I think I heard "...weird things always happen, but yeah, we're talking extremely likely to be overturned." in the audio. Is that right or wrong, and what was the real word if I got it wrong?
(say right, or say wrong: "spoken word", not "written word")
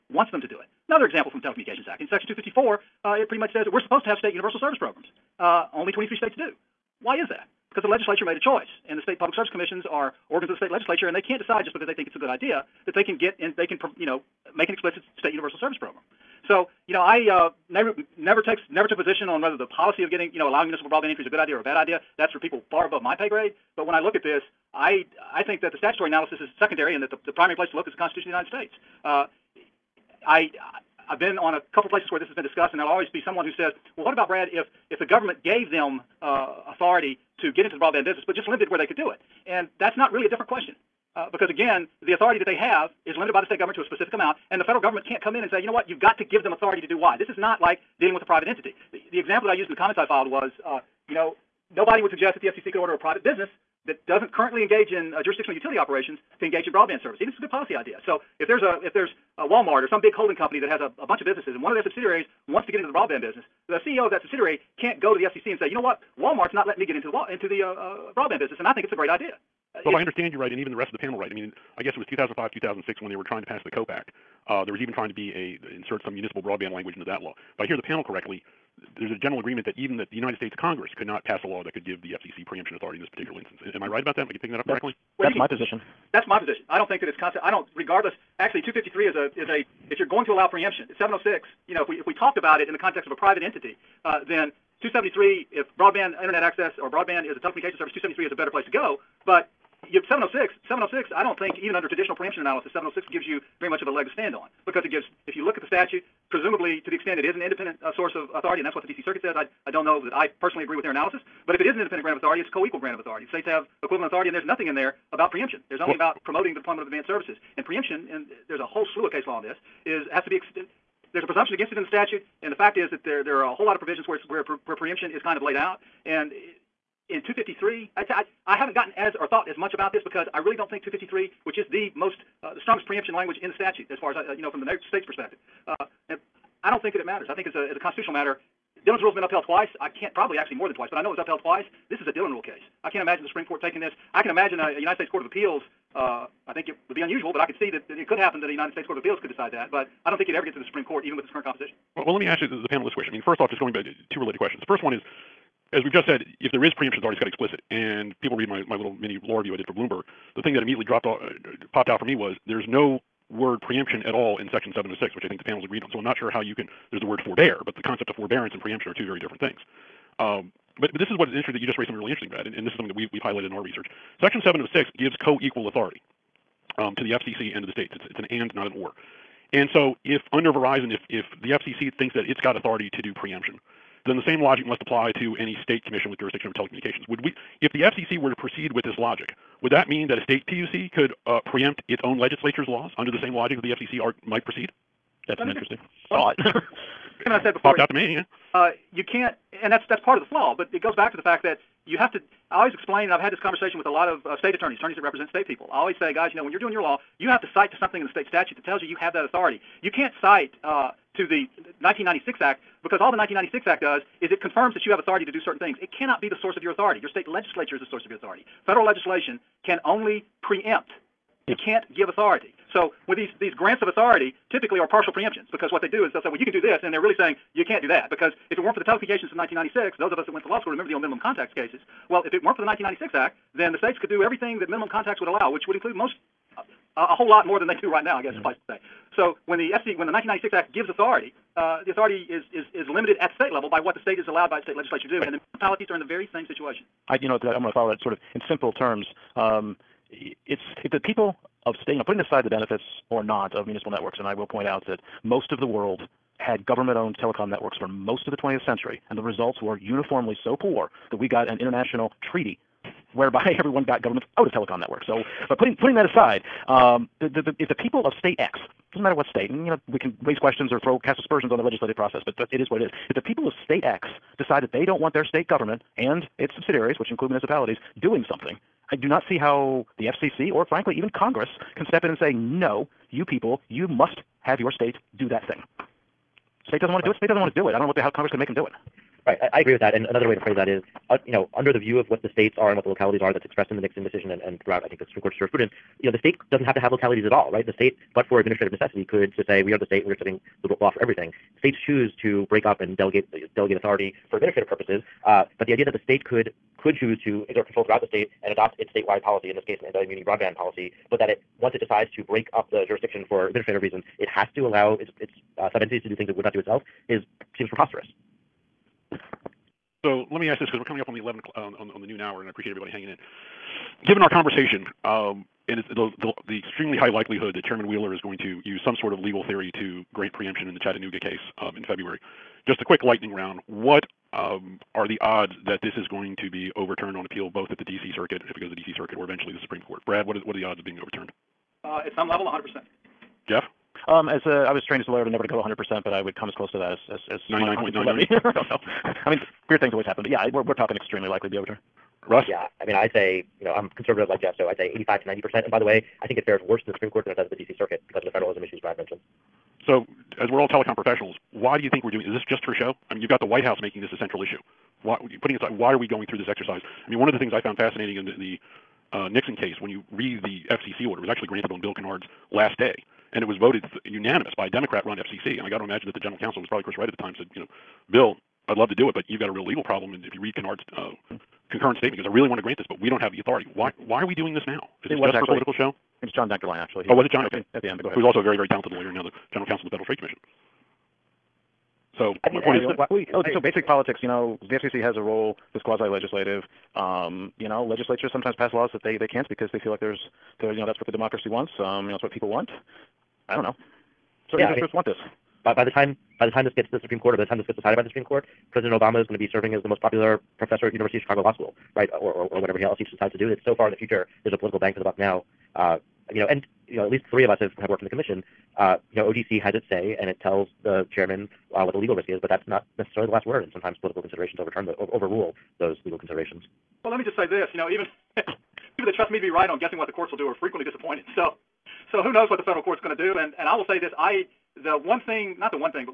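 right.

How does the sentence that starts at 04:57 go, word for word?
The state, but for administrative necessity, could just say, we are the state, and we are setting the law for everything.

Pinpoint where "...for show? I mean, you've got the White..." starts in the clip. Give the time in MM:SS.
06:02.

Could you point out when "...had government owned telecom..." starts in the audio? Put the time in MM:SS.
04:16.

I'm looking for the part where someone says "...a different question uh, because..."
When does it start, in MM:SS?
00:40.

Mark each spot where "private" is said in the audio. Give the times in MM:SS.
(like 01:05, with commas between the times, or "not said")
00:48, 00:52, 01:33.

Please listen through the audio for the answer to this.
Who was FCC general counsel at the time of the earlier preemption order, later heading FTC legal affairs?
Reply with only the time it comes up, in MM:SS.
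06:26.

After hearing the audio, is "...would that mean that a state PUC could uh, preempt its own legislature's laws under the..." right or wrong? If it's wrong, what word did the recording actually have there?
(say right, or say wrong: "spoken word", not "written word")
right.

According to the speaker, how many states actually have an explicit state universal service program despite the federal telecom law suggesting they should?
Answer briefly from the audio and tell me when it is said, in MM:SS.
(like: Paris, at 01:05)
23, at 00:05.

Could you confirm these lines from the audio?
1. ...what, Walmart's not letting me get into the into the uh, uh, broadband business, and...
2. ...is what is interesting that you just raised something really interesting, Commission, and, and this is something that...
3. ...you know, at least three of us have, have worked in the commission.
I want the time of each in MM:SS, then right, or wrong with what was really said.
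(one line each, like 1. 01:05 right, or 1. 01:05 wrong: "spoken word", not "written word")
1. 01:05 right
2. 02:51 wrong: "Brad", not "Commission"
3. 06:56 right.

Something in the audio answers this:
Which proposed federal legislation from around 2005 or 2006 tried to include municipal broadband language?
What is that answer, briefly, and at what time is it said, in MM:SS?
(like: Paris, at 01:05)
COPE Act, at 01:13.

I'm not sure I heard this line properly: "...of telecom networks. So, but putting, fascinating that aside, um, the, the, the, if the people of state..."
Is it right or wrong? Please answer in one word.
wrong.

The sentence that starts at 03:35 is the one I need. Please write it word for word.
It cannot be the source of your authority.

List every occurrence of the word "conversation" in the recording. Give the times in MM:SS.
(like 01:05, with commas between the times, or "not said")
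03:23, 05:24.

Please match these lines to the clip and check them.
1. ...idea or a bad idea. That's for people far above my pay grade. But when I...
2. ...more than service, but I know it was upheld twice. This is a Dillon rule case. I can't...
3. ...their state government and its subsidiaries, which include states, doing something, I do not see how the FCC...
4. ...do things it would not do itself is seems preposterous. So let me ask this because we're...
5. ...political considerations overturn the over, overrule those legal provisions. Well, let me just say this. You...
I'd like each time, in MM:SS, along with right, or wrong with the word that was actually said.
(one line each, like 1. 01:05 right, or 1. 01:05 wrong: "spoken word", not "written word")
1. 00:21 right
2. 02:20 wrong: "twice", not "service"
3. 04:35 wrong: "municipalities", not "states"
4. 05:16 right
5. 07:04 wrong: "considerations", not "provisions".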